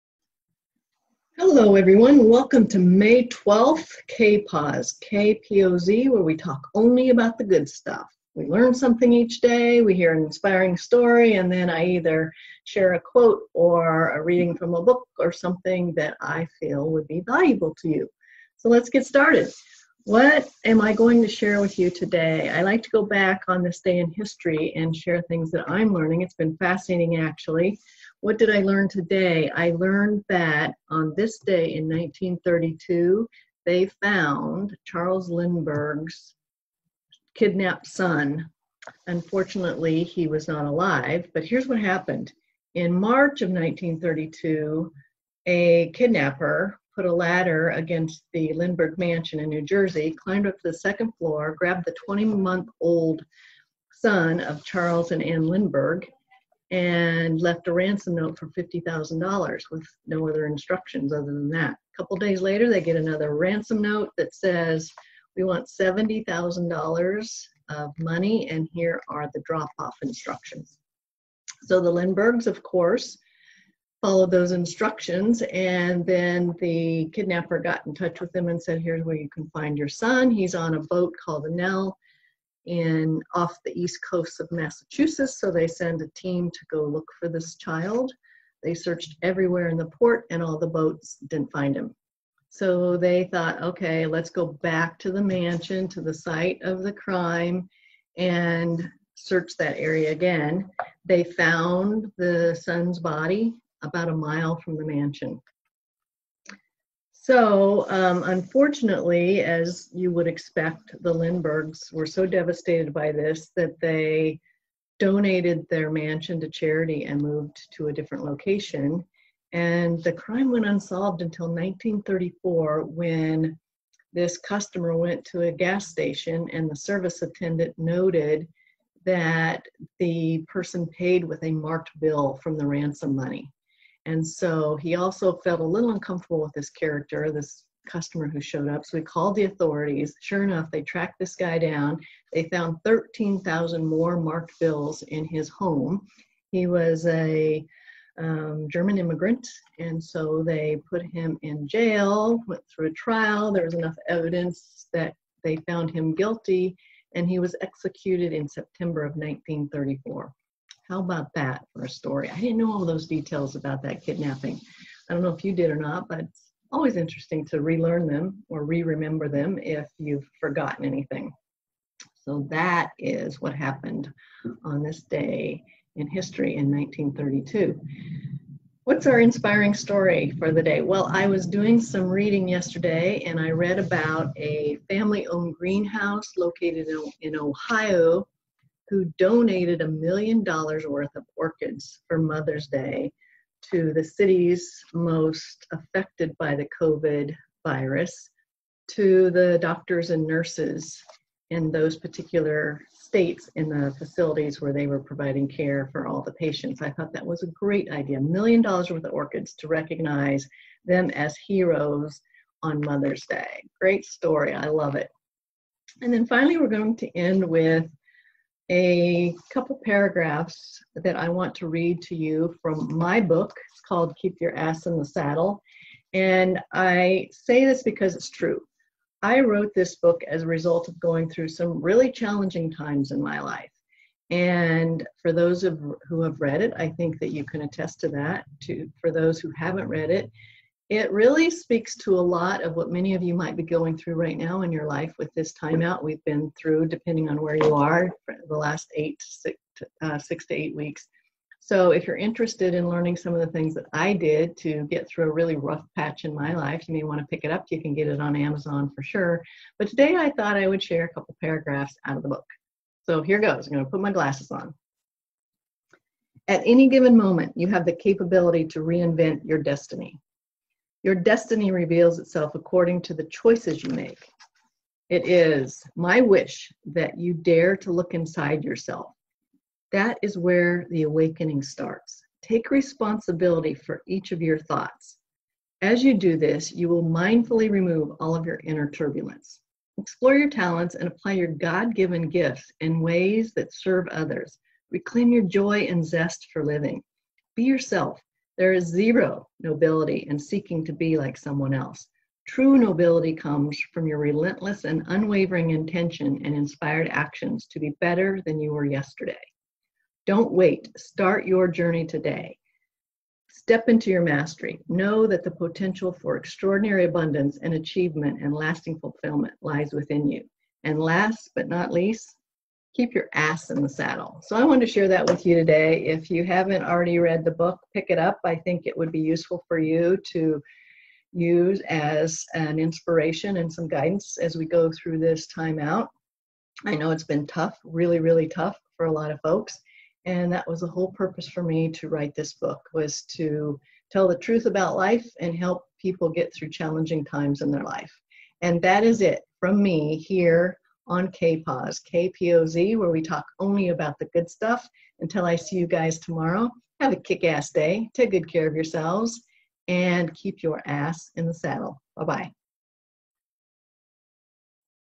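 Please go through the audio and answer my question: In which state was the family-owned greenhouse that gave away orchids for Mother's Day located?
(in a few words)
Ohio.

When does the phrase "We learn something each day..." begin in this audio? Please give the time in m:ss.
0:08.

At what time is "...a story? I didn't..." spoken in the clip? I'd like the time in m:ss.
2:41.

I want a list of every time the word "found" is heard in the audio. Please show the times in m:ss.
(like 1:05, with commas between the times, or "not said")
0:34, 1:41, 2:22, 2:35.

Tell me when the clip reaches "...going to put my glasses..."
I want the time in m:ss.
4:23.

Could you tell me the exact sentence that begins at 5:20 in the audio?
And last but not least, keep your ass in the saddle.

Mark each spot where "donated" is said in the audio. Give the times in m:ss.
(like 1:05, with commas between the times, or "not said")
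1:54, 3:09.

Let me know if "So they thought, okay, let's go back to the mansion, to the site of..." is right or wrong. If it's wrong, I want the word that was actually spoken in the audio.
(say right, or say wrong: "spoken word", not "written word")
right.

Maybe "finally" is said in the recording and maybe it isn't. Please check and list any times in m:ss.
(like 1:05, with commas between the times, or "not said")
3:36.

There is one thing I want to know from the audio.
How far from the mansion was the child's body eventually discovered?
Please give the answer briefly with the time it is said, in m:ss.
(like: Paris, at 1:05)
about a mile, at 1:43.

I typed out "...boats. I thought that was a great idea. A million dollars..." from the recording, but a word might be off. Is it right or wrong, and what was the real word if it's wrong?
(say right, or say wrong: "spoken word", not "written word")
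wrong: "patients", not "boats".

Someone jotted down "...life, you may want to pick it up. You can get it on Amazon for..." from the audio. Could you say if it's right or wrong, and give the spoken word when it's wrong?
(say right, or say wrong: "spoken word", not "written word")
right.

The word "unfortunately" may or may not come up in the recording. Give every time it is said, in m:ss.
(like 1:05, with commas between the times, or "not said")
0:39, 1:48.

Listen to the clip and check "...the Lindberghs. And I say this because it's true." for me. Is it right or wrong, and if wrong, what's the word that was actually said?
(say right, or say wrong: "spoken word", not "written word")
wrong: "Saddle", not "Lindberghs".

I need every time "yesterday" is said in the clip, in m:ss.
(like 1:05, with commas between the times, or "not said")
3:02, 5:08.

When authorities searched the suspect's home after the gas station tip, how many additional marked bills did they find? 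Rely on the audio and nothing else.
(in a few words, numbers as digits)
13,000.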